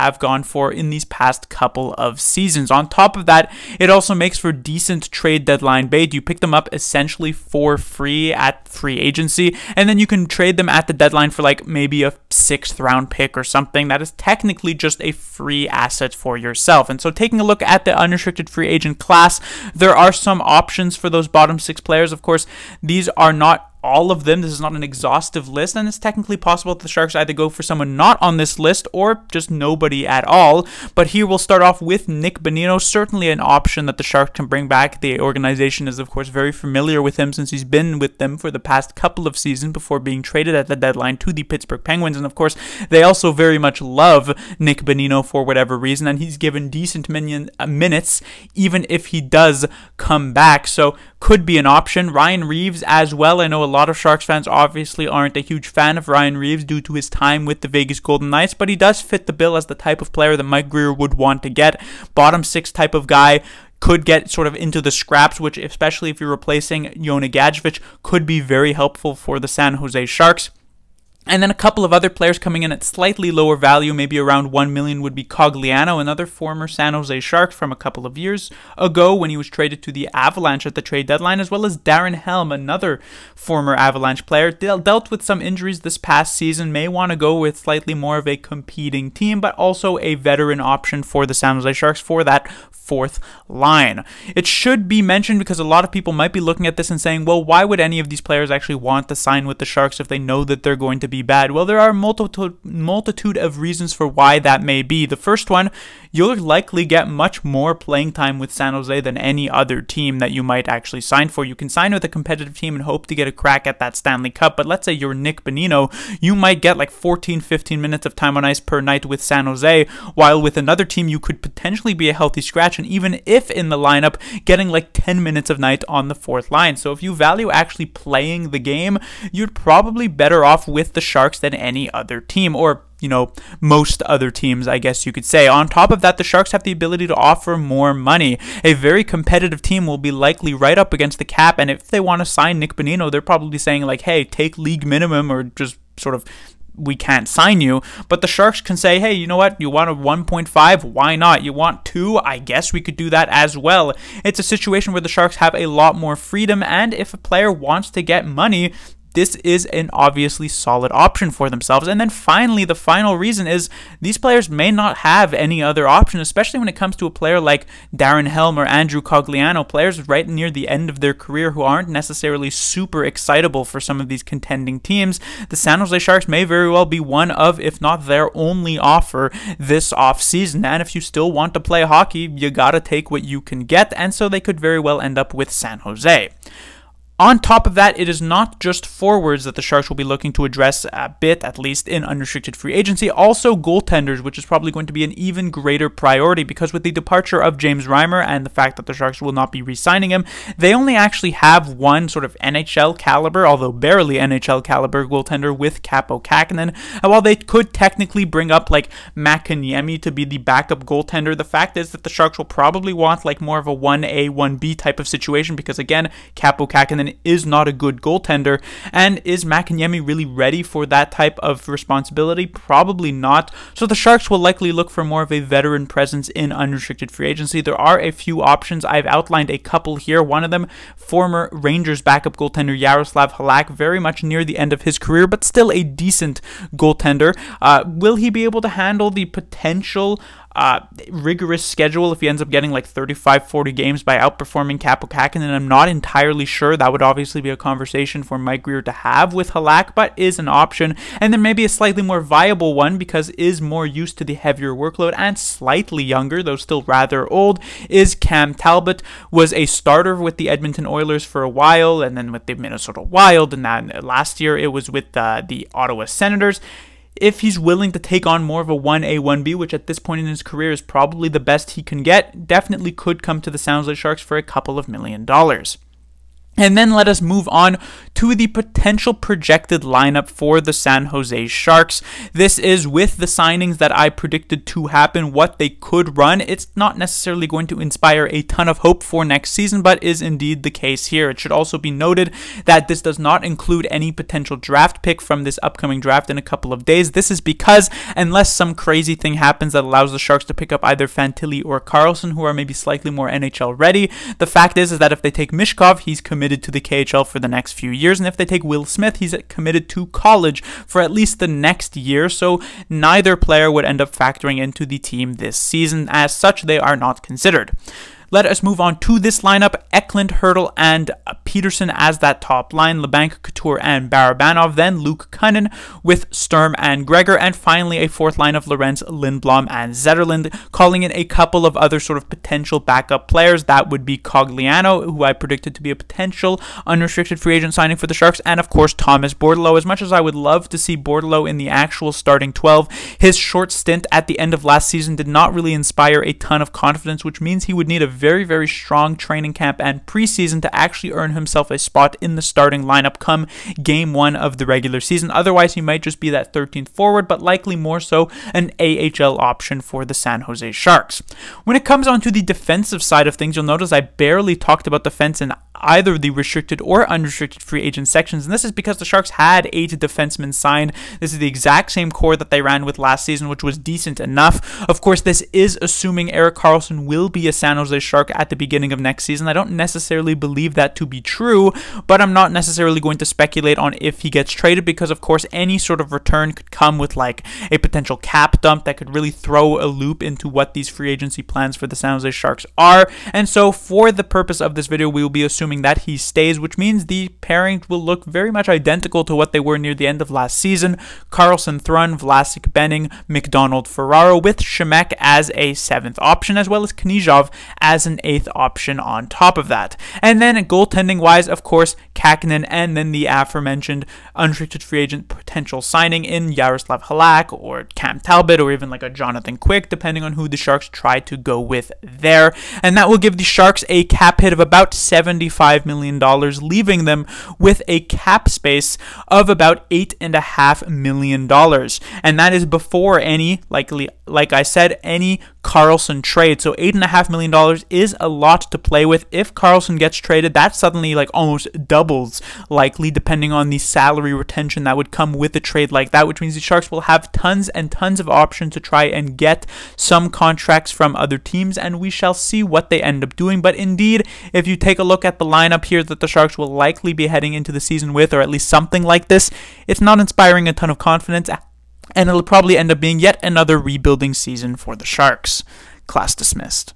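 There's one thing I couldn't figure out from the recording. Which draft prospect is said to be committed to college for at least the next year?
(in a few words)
Will Smith.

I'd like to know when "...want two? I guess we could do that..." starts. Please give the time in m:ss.
2:31.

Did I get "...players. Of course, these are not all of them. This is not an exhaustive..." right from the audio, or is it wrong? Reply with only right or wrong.
right.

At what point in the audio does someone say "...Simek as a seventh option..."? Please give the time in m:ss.
6:44.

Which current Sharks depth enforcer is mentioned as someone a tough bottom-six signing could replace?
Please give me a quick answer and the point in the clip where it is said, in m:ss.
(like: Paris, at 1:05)
Jonah Gadjovich, at 1:06.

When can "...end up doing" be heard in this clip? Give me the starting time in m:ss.
7:33.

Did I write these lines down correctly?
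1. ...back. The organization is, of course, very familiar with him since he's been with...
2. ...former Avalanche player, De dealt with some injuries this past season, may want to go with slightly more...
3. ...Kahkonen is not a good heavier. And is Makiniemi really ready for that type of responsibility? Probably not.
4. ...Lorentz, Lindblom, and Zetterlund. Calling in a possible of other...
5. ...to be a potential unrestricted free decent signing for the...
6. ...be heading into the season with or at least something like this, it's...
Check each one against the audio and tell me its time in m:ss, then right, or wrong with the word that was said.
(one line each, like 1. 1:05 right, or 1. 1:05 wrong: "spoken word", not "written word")
1. 0:34 right
2. 1:23 right
3. 3:36 wrong: "goaltender", not "heavier"
4. 5:28 wrong: "couple", not "possible"
5. 5:35 wrong: "agent", not "decent"
6. 7:37 right.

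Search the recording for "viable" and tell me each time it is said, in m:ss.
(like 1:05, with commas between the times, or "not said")
4:12.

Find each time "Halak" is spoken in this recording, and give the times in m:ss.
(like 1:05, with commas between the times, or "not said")
3:53, 4:09, 6:57.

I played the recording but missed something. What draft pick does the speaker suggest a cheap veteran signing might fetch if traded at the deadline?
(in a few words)
Sixth round pick.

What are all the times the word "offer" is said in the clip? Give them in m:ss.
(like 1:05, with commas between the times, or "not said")
2:17, 2:58.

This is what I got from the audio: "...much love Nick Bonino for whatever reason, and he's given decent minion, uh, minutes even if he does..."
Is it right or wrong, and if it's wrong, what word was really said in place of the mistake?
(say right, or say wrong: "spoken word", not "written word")
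right.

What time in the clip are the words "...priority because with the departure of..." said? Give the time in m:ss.
3:15.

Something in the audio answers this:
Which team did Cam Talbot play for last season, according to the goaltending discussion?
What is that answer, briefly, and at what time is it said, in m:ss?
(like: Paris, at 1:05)
Ottawa Senators, at 4:25.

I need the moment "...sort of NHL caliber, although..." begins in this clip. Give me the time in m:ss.
3:22.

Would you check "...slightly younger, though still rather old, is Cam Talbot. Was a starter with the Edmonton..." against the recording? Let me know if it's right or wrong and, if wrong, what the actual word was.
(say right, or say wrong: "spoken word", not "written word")
right.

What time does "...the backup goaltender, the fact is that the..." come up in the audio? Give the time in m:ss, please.
3:30.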